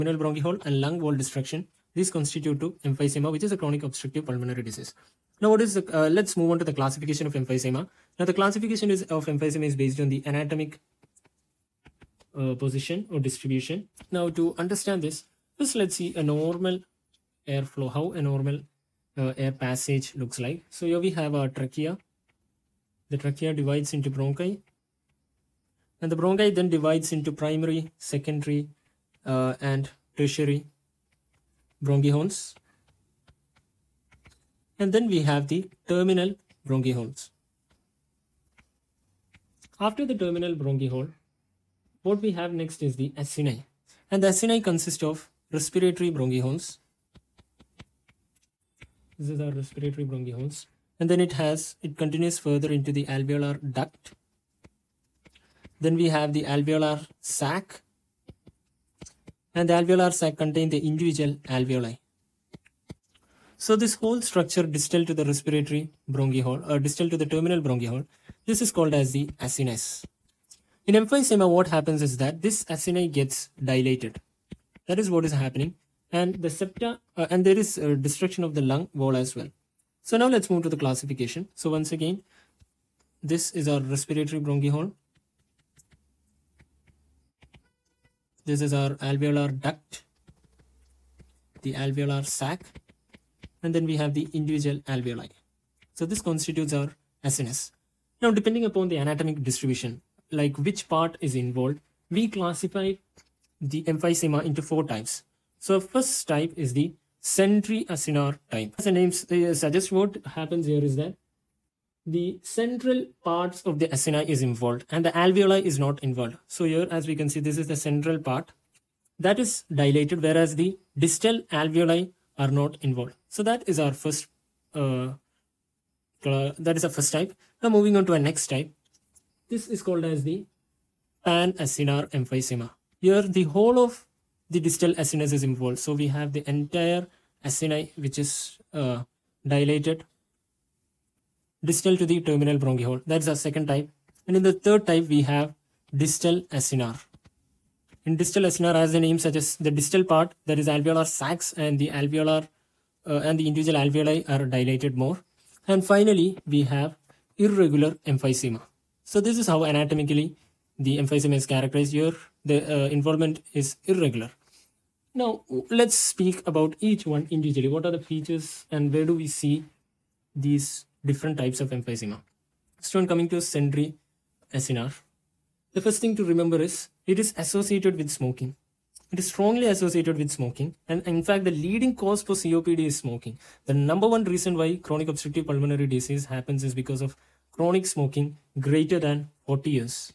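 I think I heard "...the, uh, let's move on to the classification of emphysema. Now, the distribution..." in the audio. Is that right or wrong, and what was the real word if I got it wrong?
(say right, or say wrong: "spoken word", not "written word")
wrong: "classification", not "distribution".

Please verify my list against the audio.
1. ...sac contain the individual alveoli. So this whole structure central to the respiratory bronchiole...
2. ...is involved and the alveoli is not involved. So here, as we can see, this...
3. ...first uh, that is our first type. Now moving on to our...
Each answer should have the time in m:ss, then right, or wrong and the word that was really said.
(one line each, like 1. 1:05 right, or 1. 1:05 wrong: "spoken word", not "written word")
1. 1:00 wrong: "distal", not "central"
2. 1:54 right
3. 2:03 right.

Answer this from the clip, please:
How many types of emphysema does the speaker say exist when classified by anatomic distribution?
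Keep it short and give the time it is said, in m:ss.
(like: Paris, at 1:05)
4, at 1:44.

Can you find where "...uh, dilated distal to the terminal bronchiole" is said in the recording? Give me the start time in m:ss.
2:18.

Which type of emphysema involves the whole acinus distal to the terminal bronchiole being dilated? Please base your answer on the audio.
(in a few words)
Pan-acinar emphysema.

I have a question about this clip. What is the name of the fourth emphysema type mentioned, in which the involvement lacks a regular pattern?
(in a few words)
Irregular emphysema.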